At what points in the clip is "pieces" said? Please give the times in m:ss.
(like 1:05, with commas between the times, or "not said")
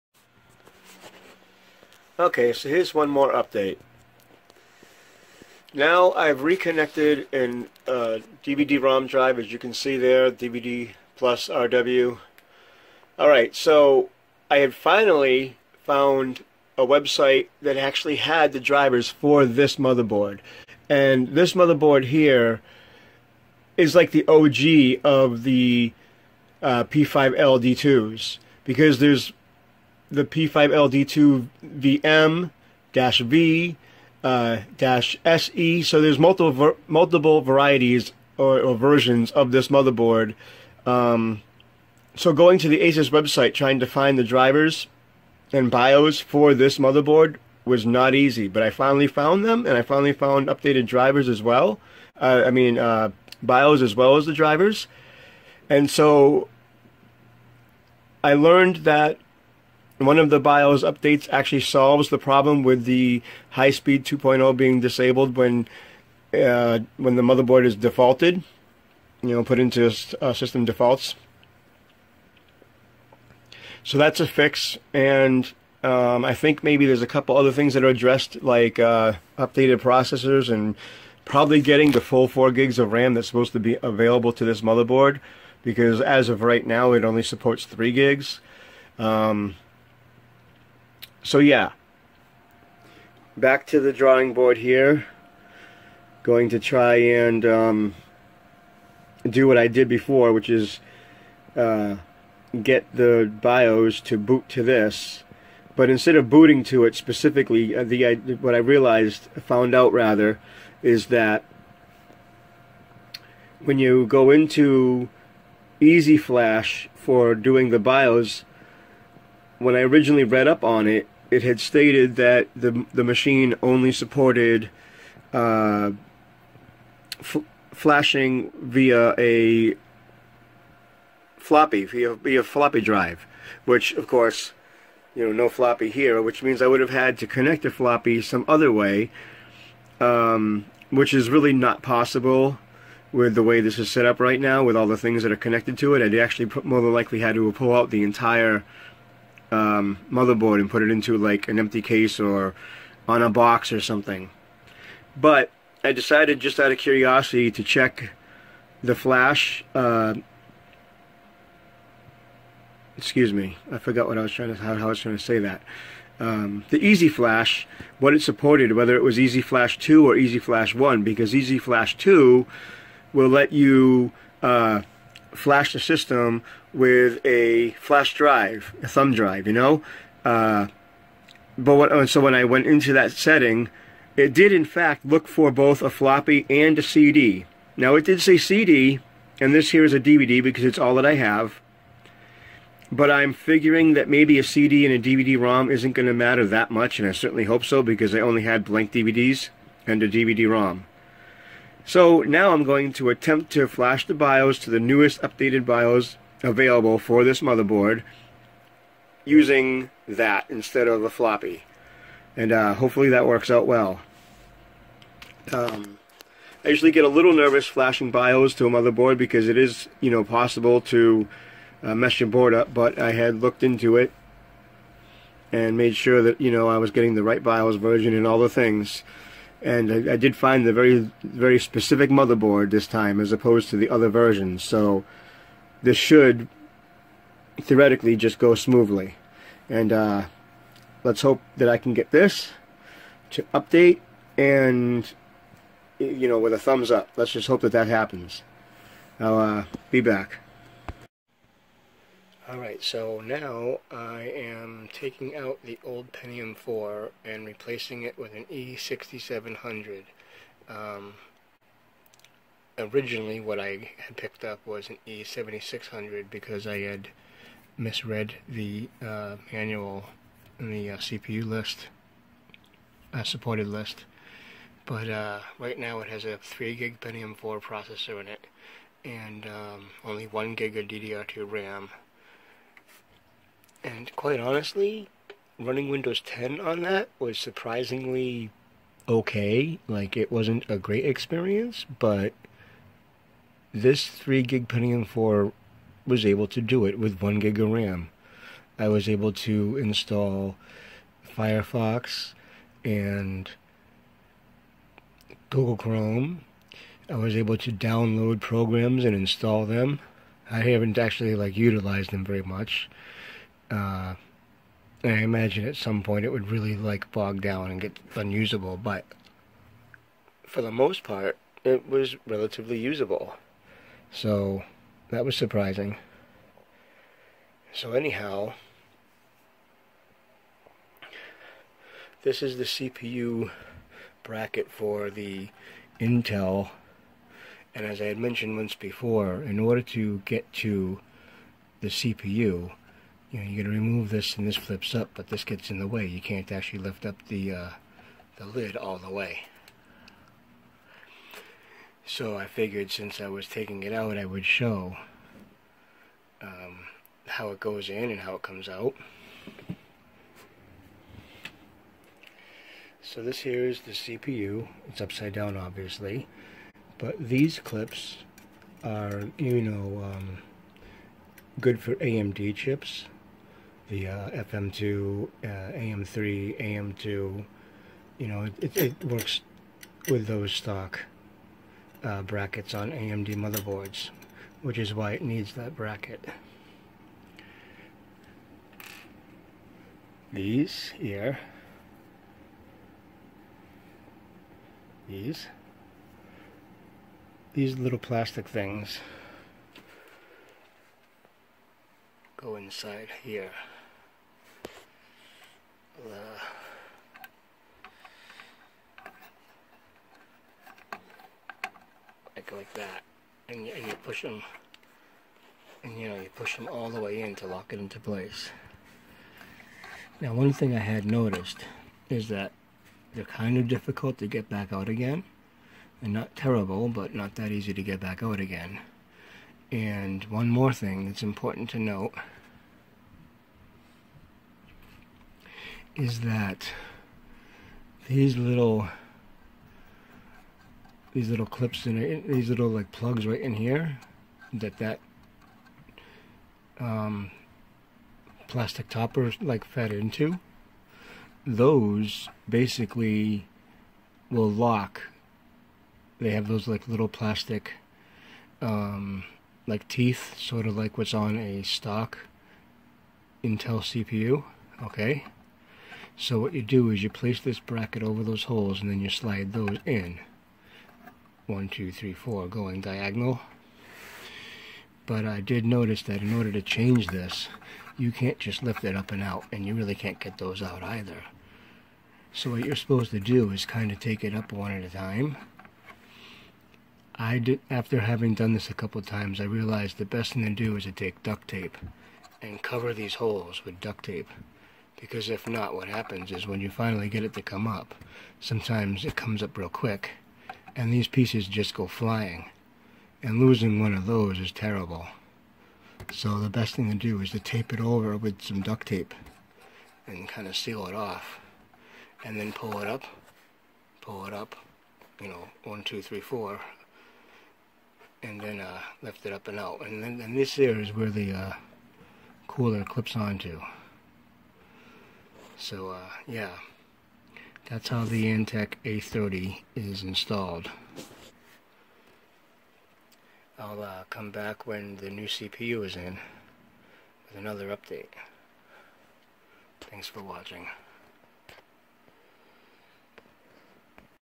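8:21.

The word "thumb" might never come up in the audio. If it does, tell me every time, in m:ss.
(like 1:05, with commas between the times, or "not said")
2:58, 4:06.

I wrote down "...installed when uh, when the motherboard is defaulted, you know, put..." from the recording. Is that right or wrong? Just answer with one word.
wrong.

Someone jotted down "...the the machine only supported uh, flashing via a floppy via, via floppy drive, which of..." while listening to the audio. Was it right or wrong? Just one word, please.
right.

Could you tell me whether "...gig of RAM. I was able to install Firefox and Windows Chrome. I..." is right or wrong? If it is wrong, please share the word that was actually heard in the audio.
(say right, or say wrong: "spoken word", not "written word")
wrong: "Google", not "Windows".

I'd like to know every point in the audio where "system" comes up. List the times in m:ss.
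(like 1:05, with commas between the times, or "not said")
1:10, 2:55.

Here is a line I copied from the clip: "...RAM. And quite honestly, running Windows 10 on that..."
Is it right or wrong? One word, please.
right.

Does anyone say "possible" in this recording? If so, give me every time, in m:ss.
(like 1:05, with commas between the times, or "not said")
2:21, 3:40.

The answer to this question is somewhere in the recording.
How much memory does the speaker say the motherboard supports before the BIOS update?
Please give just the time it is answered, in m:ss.
1:27.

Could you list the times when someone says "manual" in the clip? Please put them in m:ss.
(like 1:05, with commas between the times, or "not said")
4:29.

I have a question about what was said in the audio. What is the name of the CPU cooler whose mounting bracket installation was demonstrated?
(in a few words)
Antec A30.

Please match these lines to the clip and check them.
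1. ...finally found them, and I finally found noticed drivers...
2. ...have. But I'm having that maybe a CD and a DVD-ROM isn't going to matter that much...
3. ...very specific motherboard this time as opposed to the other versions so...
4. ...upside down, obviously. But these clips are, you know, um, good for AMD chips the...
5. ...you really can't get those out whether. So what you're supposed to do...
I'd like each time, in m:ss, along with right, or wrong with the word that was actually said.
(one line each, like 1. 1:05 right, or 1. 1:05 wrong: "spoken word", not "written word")
1. 0:48 wrong: "updated", not "noticed"
2. 3:11 wrong: "figuring", not "having"
3. 3:51 right
4. 6:04 right
5. 7:59 wrong: "either", not "whether".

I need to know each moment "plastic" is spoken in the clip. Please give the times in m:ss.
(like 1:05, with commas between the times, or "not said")
6:37, 7:28, 7:37.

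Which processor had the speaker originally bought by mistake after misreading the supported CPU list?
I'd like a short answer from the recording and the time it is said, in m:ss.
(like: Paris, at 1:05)
E7600, at 4:25.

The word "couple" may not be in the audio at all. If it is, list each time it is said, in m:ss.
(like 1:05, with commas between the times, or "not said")
1:17, 8:08.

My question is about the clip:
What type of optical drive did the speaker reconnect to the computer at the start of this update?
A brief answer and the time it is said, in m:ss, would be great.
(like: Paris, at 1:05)
DVD-ROM drive, at 0:08.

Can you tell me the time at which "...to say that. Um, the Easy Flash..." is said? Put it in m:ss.
2:45.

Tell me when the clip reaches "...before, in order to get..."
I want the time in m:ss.
5:38.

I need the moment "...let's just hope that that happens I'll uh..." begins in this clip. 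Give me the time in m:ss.
4:07.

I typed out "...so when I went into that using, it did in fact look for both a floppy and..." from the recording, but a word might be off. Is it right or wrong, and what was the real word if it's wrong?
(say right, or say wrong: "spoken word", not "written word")
wrong: "setting", not "using".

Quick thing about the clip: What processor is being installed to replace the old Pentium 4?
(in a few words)
E6700.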